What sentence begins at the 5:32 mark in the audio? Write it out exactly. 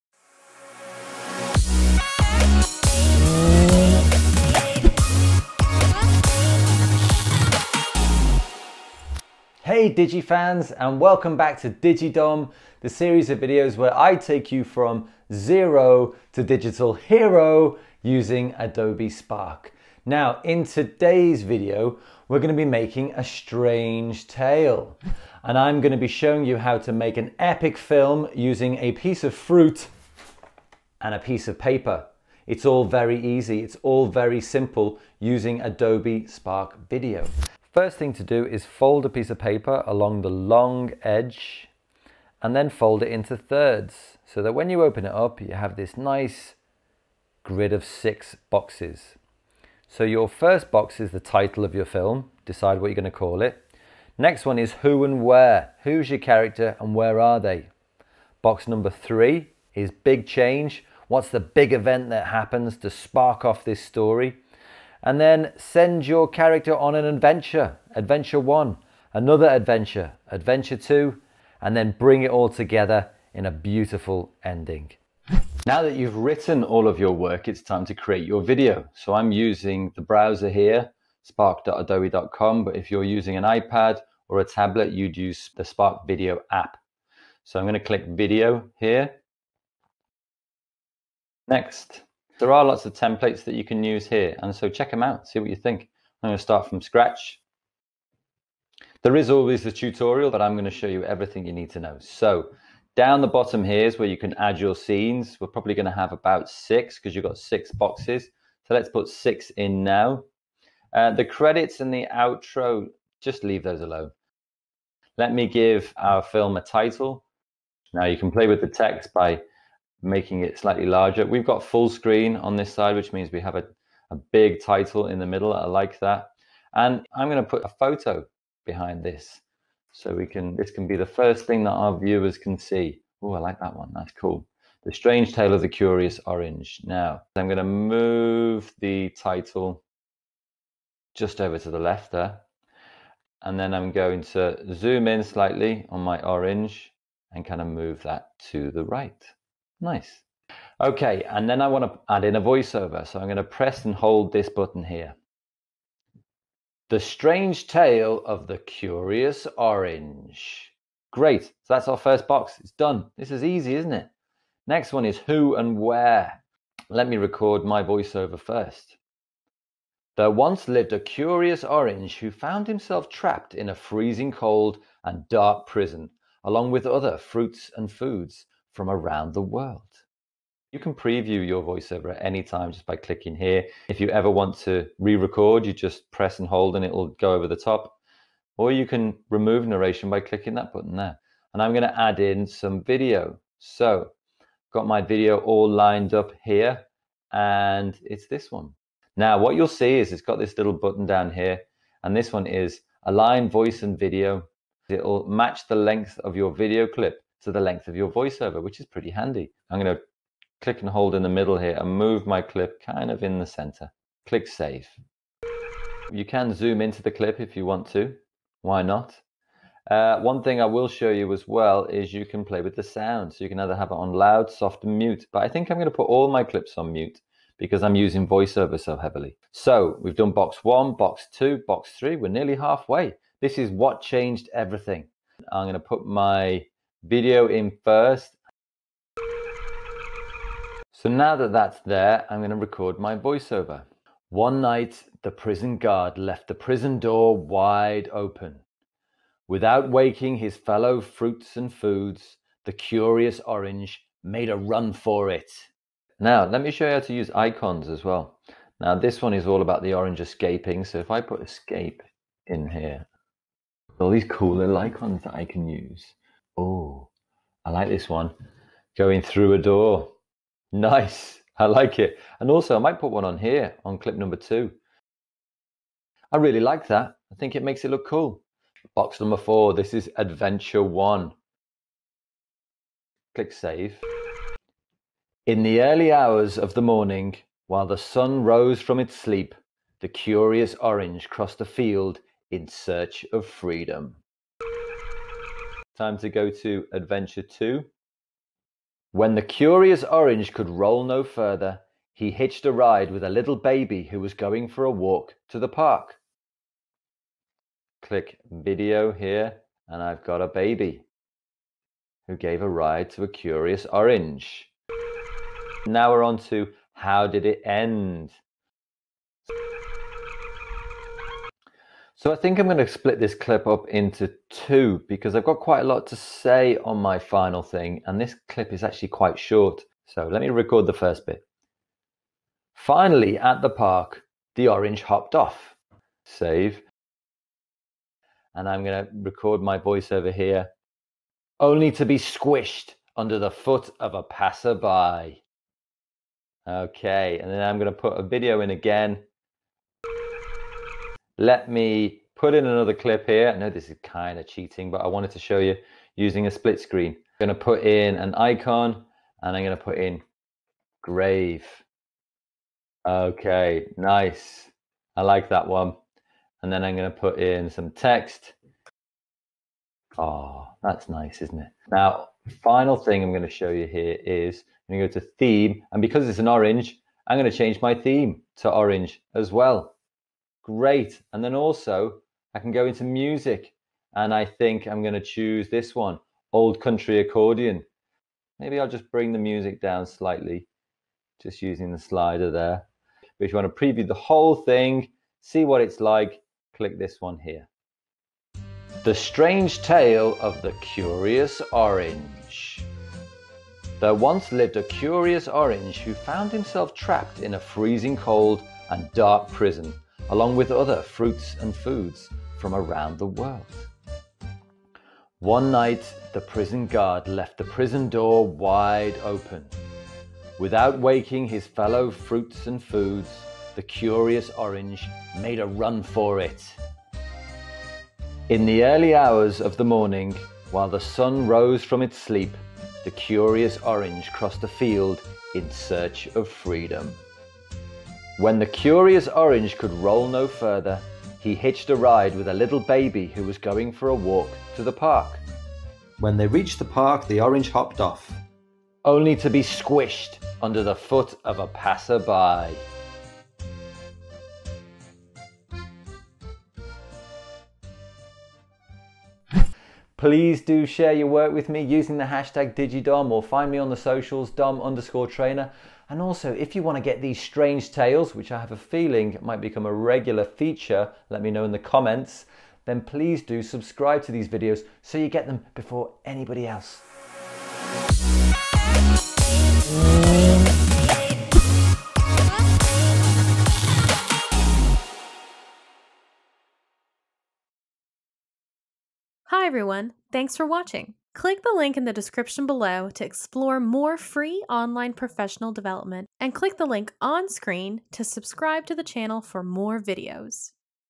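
Finally, at the park, the orange hopped off.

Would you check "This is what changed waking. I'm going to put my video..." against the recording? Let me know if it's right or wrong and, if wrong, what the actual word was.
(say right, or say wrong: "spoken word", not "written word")
wrong: "everything", not "waking".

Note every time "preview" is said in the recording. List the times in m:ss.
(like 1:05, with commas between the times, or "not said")
3:00, 6:33.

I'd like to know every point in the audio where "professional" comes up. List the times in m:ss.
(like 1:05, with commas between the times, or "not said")
8:15.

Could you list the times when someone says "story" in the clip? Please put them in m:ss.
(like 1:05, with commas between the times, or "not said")
1:03.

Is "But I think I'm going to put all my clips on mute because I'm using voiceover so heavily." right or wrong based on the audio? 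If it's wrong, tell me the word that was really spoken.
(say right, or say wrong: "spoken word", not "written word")
right.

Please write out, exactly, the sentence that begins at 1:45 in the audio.
We're probably going to have about six because you've got six boxes.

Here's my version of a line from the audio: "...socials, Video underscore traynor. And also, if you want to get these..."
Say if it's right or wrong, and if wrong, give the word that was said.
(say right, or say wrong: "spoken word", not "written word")
wrong: "Dom", not "Video".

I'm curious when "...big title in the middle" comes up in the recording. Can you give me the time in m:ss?
2:04.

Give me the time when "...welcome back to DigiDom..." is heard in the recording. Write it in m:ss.
0:10.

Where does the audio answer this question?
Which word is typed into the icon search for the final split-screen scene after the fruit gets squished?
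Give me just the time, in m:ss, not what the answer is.
6:01.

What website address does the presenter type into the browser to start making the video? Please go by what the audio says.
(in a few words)
spark.adobe.com.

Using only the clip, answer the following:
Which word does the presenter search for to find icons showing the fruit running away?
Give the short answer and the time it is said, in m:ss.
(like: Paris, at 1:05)
escape, at 4:21.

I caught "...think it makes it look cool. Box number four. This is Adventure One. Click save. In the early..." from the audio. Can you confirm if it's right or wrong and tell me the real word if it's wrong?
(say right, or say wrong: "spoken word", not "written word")
right.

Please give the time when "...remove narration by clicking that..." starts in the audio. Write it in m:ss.
3:09.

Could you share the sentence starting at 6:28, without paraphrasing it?
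Maybe I'll just bring the music down slightly, just using the slider there.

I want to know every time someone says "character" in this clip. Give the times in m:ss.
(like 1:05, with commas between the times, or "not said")
0:56, 1:06.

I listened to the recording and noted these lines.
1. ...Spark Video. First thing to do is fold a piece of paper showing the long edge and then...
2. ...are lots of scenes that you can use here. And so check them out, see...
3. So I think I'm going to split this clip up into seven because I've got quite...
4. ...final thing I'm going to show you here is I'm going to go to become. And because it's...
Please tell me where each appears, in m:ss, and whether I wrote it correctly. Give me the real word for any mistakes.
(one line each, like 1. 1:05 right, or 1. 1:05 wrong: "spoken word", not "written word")
1. 0:36 wrong: "along", not "showing"
2. 1:32 wrong: "templates", not "scenes"
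3. 5:22 wrong: "two", not "seven"
4. 6:12 wrong: "theme", not "become".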